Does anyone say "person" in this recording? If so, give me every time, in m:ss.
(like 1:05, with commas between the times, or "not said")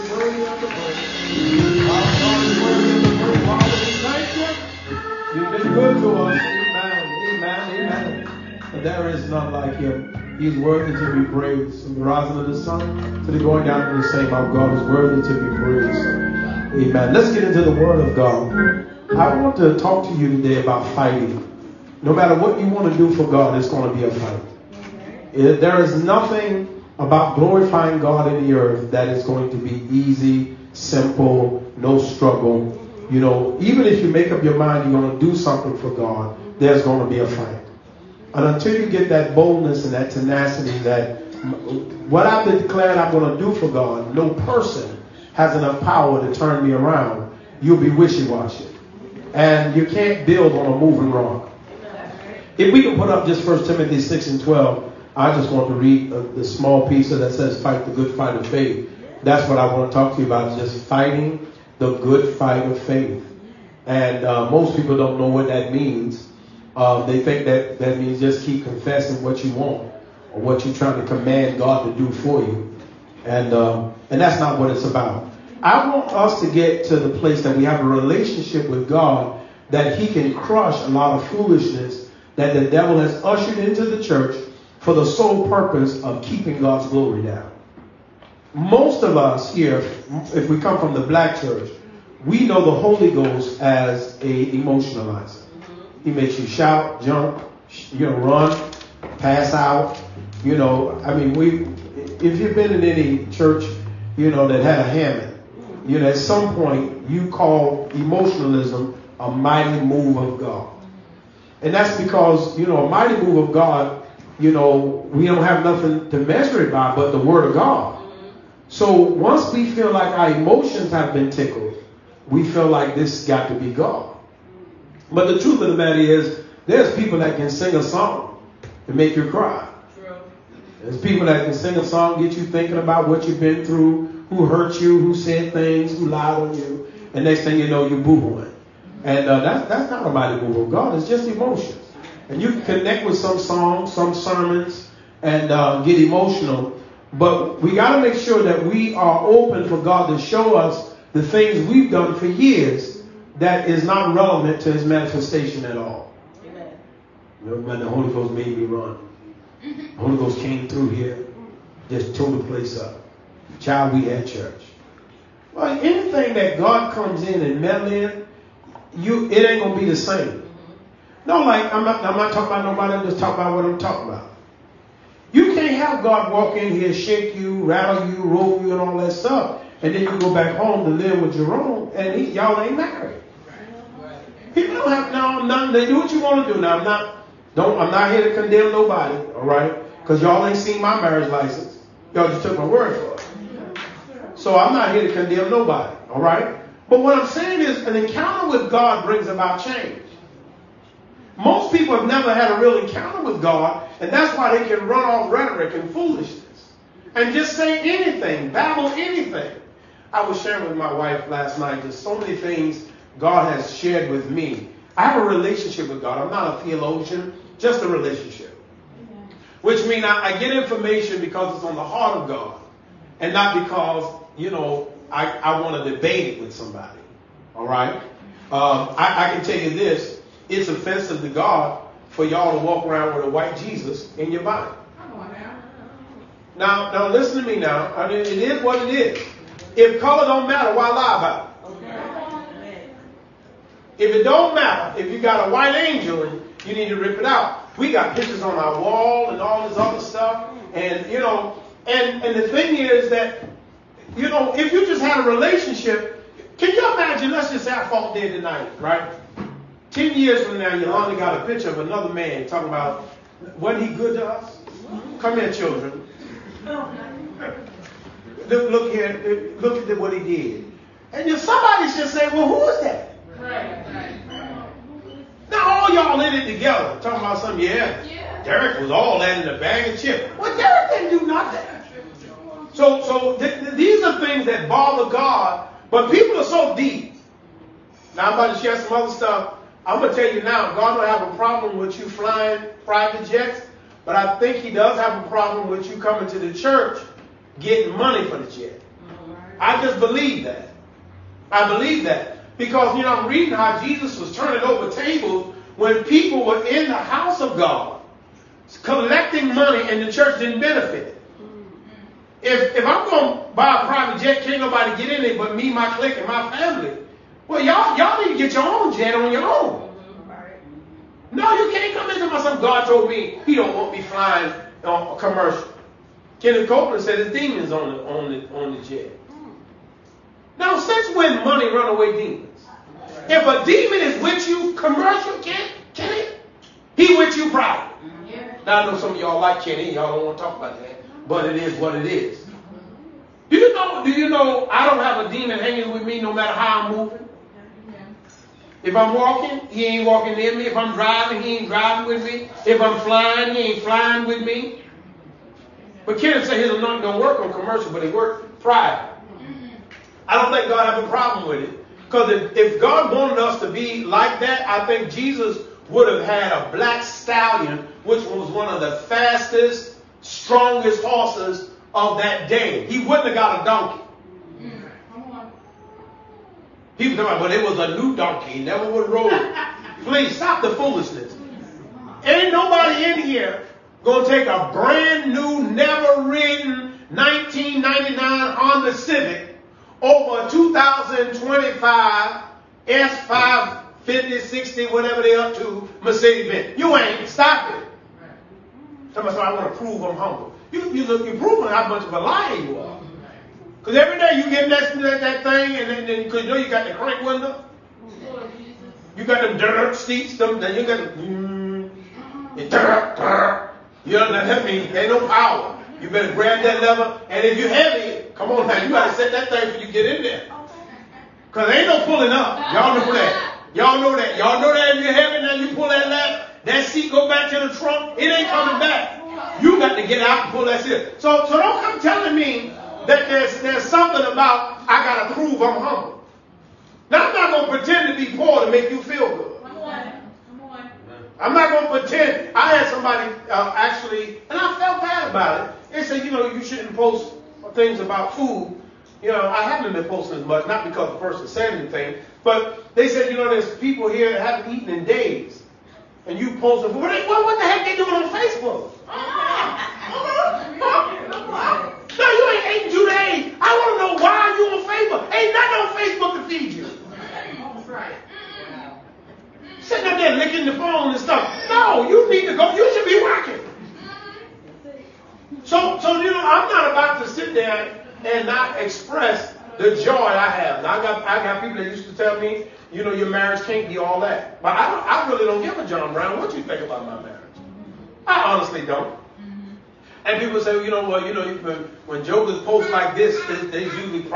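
0:44, 7:31.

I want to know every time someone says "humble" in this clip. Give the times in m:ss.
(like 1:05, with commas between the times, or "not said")
6:40, 7:15.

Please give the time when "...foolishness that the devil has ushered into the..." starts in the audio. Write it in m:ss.
1:21.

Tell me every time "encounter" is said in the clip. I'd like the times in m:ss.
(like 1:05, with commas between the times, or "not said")
3:17, 3:22.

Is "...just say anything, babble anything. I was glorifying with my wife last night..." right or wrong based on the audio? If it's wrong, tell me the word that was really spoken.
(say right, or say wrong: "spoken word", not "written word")
wrong: "sharing", not "glorifying".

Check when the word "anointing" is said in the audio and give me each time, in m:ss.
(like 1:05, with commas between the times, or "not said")
5:56.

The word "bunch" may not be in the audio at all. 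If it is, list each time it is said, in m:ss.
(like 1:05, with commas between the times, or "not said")
not said.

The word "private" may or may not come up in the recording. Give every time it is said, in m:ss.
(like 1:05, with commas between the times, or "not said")
4:52, 5:13, 5:37, 5:58.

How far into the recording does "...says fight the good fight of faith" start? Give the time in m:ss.
0:57.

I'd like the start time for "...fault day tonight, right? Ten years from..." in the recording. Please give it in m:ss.
4:17.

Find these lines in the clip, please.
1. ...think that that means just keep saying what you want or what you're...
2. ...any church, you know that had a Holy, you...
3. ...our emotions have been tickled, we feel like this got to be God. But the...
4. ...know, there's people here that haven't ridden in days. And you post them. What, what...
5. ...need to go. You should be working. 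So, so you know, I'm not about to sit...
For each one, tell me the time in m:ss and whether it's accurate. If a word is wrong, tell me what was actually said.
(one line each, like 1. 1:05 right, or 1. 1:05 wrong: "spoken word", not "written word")
1. 1:07 wrong: "confessing", not "saying"
2. 1:42 wrong: "Hammond", not "Holy"
3. 2:00 right
4. 7:33 wrong: "eaten", not "ridden"
5. 7:52 right.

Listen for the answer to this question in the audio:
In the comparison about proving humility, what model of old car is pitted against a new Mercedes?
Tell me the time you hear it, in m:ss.
6:28.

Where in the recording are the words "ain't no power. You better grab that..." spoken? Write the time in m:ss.
6:54.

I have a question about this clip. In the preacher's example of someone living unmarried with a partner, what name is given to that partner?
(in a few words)
Jerome.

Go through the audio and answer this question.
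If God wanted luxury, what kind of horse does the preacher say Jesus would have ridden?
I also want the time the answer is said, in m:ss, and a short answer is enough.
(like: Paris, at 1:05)
black stallion, at 6:06.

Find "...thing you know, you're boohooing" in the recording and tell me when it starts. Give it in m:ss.
2:17.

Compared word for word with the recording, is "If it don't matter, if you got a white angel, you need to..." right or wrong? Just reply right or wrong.
right.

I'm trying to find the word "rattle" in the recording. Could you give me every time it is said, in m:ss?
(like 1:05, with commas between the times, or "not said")
2:57.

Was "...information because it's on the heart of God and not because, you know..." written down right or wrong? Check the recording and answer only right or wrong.
right.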